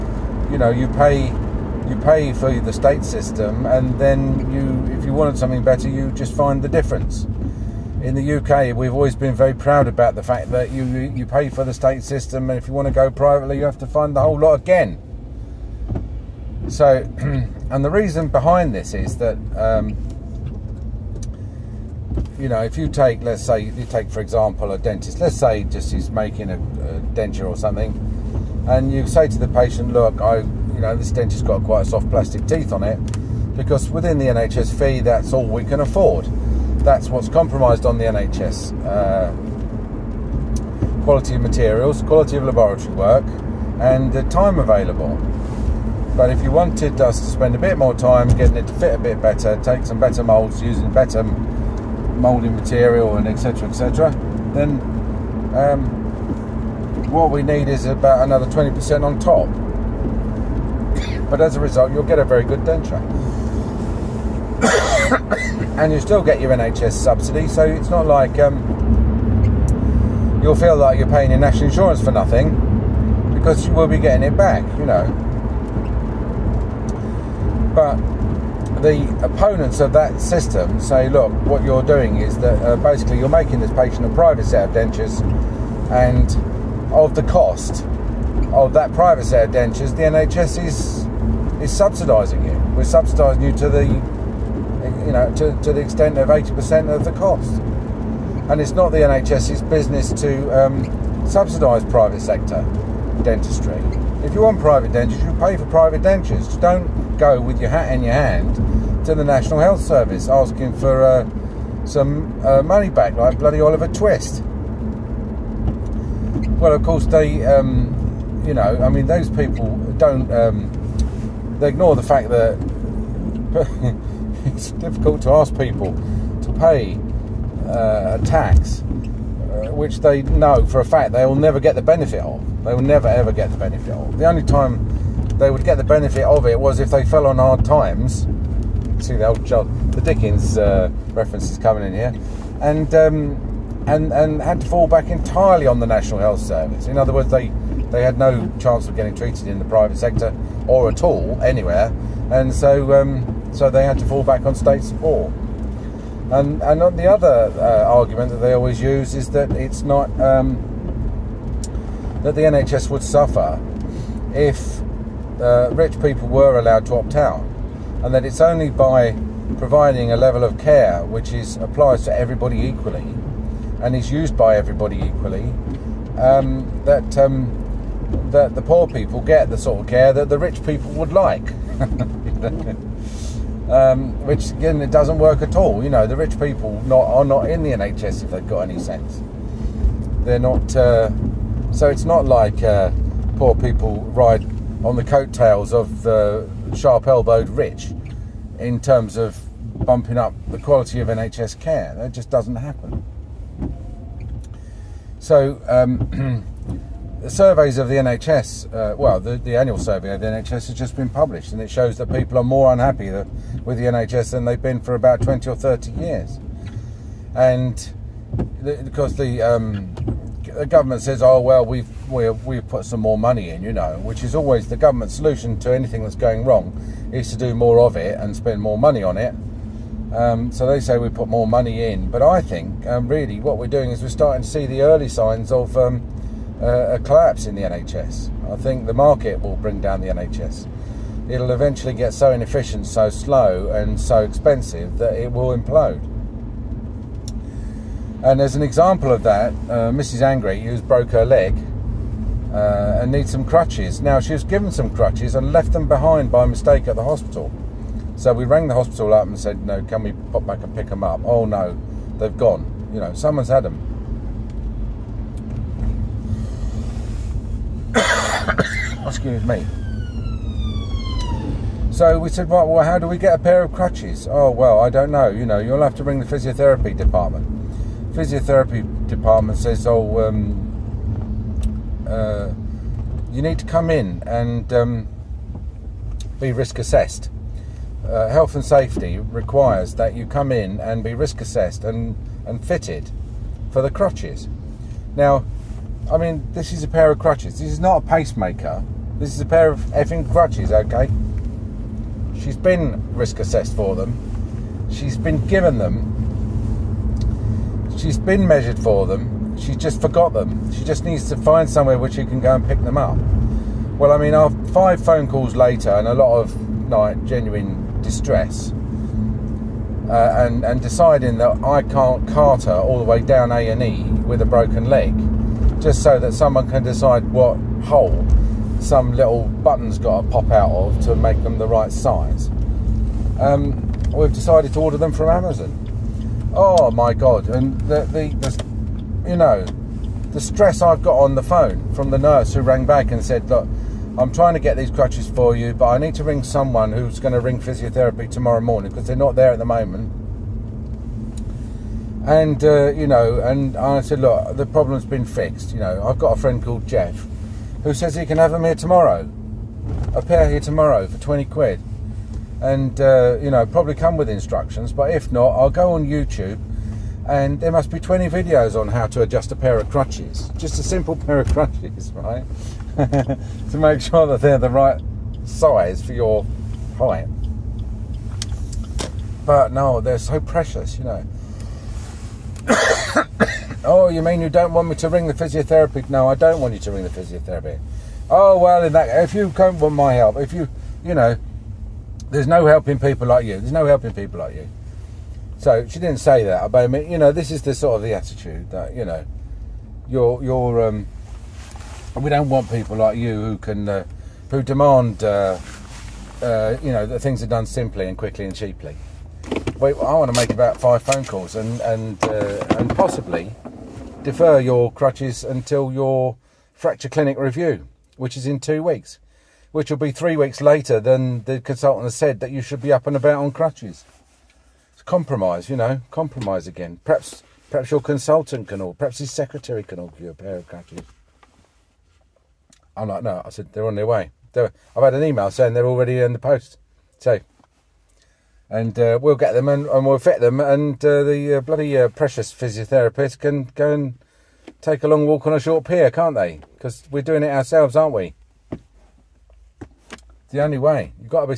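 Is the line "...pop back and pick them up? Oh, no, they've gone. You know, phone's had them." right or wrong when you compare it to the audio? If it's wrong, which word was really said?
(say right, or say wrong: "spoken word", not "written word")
wrong: "someone", not "phone".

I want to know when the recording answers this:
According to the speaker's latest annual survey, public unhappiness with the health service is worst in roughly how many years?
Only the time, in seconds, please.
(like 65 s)
215 s.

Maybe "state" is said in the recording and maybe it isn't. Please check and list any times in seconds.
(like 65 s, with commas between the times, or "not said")
2 s, 11 s, 154 s.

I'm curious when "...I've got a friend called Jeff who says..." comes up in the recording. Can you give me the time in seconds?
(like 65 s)
356 s.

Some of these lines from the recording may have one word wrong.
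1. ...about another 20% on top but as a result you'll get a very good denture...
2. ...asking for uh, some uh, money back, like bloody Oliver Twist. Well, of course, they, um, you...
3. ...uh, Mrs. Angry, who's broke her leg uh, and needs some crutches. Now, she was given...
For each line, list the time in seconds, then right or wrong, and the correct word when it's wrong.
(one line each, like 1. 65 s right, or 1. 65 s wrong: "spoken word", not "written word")
1. 57 s right
2. 110 s right
3. 249 s right.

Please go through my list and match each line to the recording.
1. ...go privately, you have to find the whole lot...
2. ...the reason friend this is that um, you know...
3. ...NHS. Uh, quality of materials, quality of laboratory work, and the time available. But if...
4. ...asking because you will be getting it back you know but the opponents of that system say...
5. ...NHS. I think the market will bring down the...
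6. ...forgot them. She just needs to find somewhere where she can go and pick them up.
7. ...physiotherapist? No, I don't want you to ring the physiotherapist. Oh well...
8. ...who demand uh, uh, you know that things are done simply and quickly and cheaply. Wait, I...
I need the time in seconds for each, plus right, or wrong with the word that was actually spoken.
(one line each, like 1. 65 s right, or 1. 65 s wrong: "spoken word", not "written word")
1. 12 s right
2. 17 s wrong: "behind", not "friend"
3. 38 s right
4. 72 s wrong: "nothing", not "asking"
5. 237 s right
6. 310 s right
7. 385 s right
8. 404 s right.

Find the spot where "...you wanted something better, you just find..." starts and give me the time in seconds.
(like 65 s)
5 s.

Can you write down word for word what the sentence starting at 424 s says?
It's compromise, you know, compromise again.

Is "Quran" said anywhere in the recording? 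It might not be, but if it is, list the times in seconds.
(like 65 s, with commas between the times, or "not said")
not said.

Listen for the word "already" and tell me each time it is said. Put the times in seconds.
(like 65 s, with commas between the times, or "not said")
435 s.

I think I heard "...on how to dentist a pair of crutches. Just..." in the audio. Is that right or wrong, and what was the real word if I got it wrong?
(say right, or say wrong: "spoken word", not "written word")
wrong: "adjust", not "dentist".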